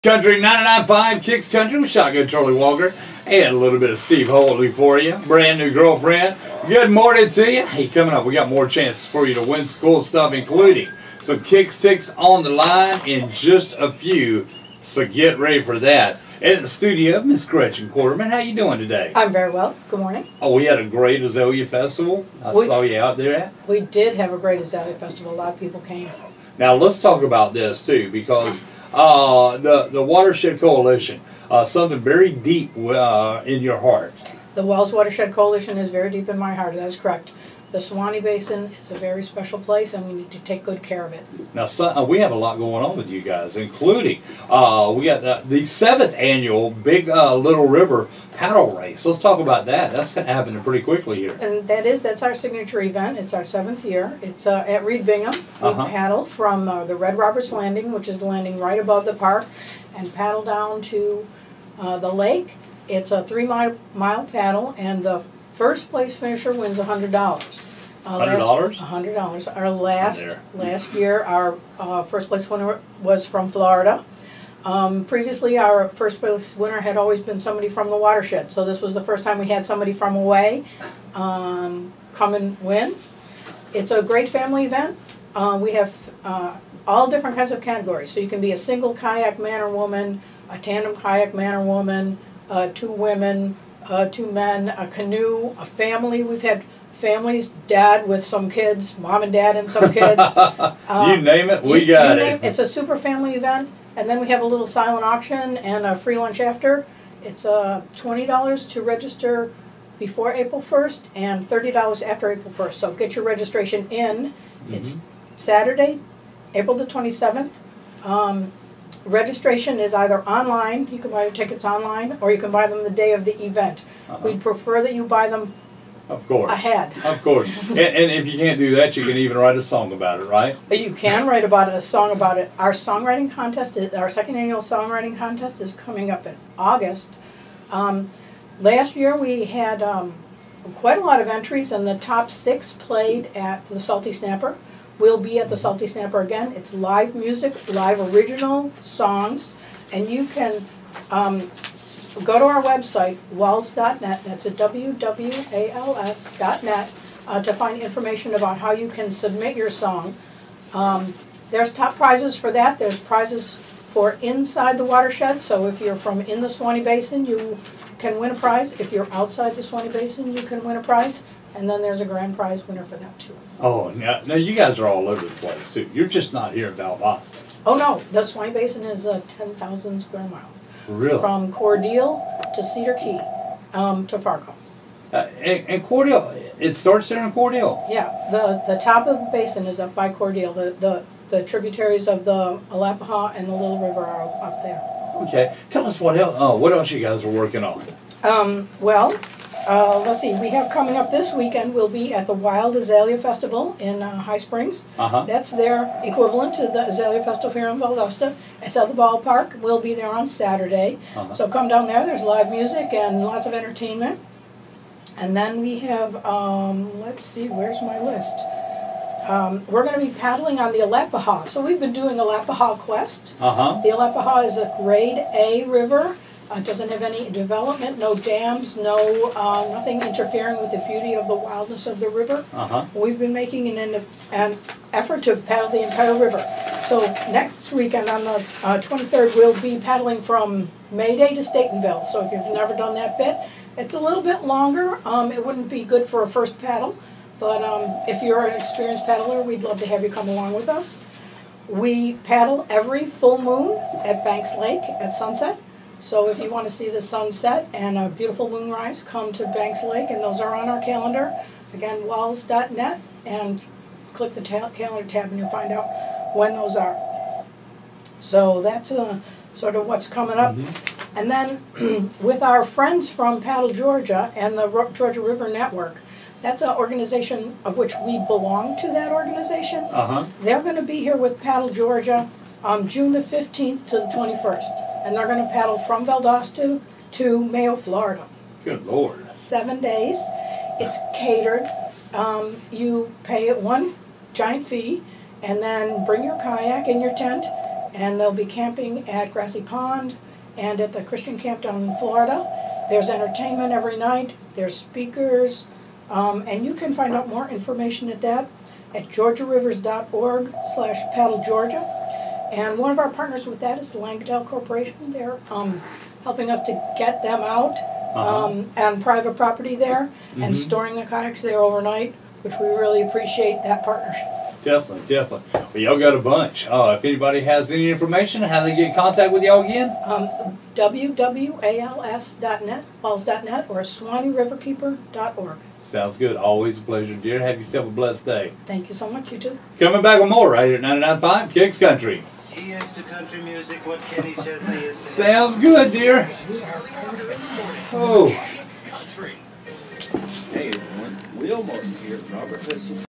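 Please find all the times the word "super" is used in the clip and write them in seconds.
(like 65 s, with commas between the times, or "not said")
102 s.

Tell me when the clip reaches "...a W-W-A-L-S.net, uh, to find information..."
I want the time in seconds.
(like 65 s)
154 s.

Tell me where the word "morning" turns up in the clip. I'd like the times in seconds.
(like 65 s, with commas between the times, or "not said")
6 s, 19 s.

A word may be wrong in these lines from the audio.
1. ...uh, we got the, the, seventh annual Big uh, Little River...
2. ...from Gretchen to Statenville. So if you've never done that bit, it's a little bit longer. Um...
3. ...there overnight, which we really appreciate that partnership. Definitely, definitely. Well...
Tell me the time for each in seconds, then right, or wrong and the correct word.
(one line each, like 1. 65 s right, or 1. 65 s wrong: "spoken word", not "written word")
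1. 44 s right
2. 240 s wrong: "Mayday", not "Gretchen"
3. 321 s right.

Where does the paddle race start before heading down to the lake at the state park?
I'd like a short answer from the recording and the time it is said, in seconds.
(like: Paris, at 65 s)
Red Roberts Landing, at 56 s.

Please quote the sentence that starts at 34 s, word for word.
The WWALS Watershed Coalition is very deep in my heart.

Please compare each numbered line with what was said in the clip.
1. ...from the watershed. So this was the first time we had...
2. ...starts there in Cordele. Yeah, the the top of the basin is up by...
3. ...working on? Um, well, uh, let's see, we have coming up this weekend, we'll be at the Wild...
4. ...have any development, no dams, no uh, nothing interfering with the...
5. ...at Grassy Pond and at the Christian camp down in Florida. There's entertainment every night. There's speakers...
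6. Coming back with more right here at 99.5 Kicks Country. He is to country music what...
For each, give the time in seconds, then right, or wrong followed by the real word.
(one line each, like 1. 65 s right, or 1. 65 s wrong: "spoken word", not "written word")
1. 77 s right
2. 186 s right
3. 197 s right
4. 226 s right
5. 299 s right
6. 339 s right.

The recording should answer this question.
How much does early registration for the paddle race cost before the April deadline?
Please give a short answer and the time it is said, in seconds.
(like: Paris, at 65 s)
$20, at 107 s.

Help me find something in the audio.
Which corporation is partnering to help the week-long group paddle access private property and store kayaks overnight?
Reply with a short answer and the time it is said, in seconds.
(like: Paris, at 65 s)
Langdale Corporation, at 313 s.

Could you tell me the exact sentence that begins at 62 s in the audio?
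It's a three mile, mile paddle, and the first place finisher wins hundred dollars.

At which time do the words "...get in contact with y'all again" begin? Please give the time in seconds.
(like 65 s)
328 s.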